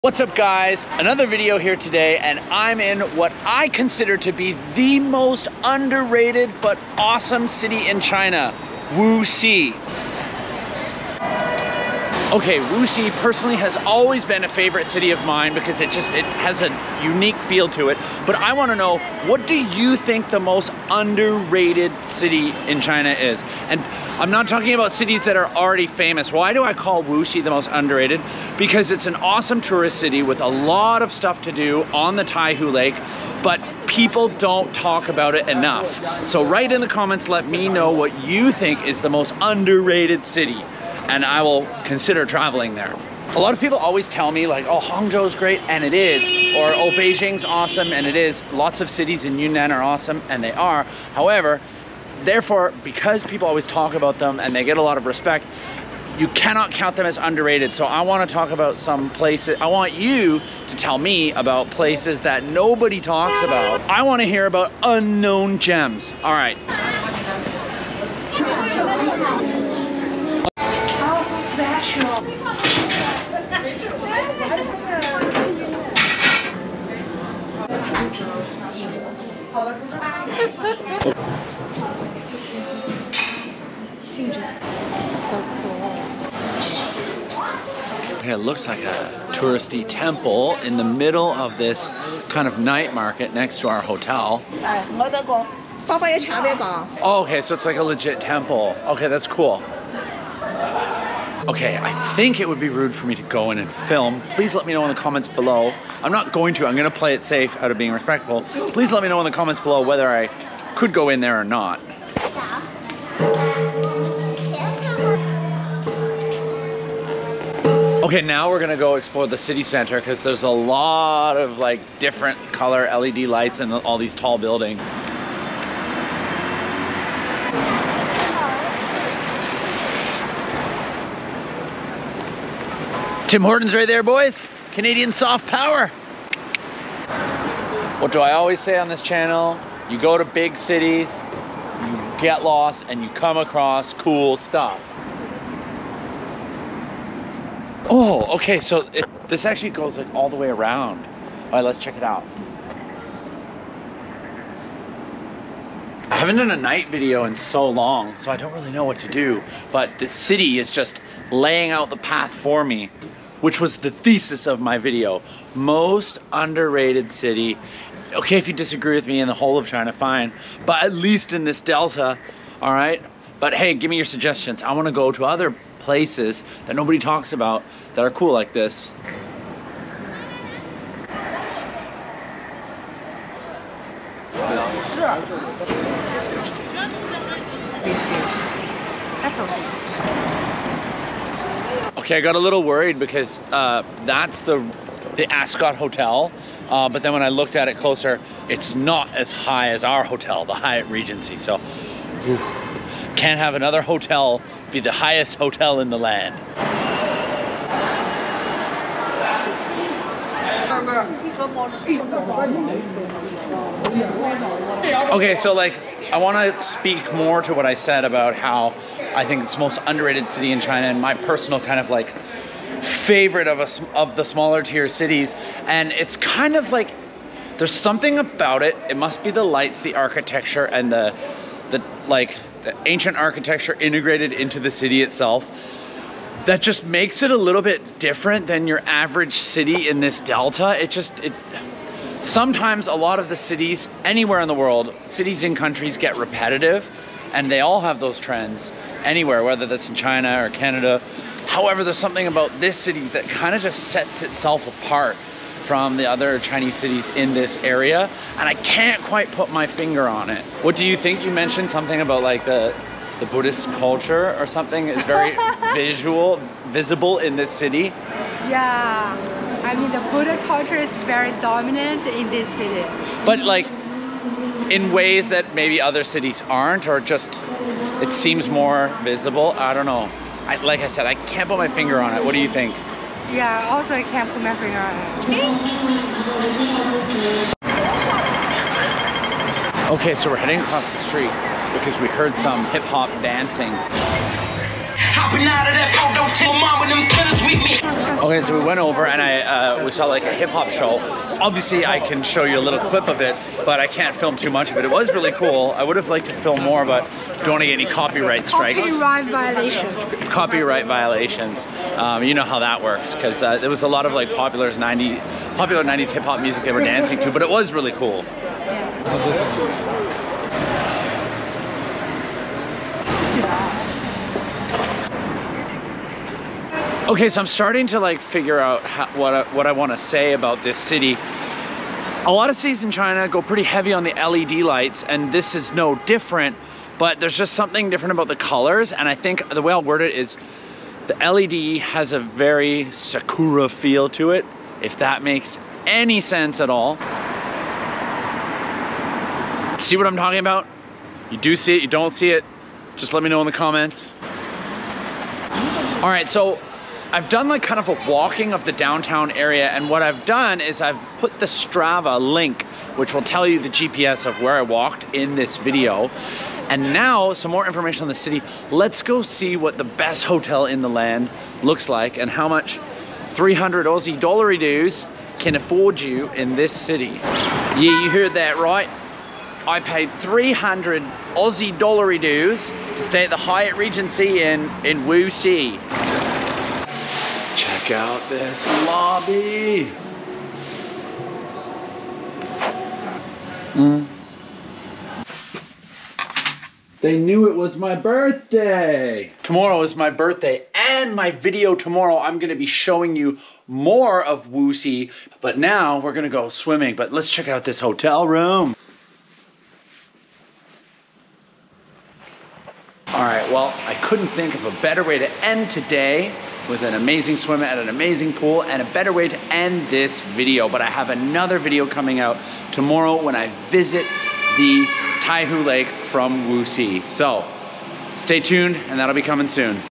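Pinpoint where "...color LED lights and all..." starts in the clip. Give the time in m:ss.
2:02.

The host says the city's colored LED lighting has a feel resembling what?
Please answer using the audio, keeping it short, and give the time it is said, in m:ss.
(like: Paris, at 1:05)
Sakura, at 5:42.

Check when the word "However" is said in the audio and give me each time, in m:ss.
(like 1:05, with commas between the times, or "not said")
0:51, 4:11.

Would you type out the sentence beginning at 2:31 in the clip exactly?
All right, let's check it out.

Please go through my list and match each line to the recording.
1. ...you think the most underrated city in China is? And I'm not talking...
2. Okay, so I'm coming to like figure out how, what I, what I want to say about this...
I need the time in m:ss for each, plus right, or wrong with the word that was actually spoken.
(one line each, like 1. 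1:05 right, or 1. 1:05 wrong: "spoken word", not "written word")
1. 0:19 right
2. 5:27 wrong: "starting", not "coming".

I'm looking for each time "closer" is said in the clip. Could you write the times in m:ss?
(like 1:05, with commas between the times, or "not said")
3:17.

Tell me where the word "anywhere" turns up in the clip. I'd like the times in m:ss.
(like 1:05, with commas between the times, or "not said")
4:04, 4:09.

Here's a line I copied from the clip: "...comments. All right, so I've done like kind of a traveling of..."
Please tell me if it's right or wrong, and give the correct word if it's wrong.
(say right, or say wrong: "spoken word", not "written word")
wrong: "walking", not "traveling".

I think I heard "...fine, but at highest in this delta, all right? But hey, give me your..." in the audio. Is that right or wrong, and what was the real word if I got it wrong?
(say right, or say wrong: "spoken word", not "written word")
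wrong: "least", not "highest".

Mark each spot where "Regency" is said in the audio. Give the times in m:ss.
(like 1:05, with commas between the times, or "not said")
3:20, 6:23.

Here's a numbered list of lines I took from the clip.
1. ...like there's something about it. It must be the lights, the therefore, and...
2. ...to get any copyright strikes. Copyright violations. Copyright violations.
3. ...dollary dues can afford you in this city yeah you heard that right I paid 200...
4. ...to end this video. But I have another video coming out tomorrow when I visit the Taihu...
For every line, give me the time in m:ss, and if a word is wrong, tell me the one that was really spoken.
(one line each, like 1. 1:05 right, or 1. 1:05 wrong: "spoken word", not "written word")
1. 3:46 wrong: "architecture", not "therefore"
2. 5:07 right
3. 6:14 wrong: "300", not "200"
4. 6:59 right.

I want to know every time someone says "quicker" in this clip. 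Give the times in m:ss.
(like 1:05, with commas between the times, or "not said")
not said.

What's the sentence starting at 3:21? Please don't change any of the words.
So, oof, can't have another hotel be the highest hotel in the land.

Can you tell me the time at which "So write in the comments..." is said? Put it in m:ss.
0:36.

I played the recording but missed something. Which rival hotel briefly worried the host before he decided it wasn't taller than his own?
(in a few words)
Ascott Hotel.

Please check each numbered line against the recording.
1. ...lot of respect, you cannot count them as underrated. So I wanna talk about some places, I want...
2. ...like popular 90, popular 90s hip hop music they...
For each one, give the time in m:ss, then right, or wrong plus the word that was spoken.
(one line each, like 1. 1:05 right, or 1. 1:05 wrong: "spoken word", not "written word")
1. 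0:54 right
2. 5:14 right.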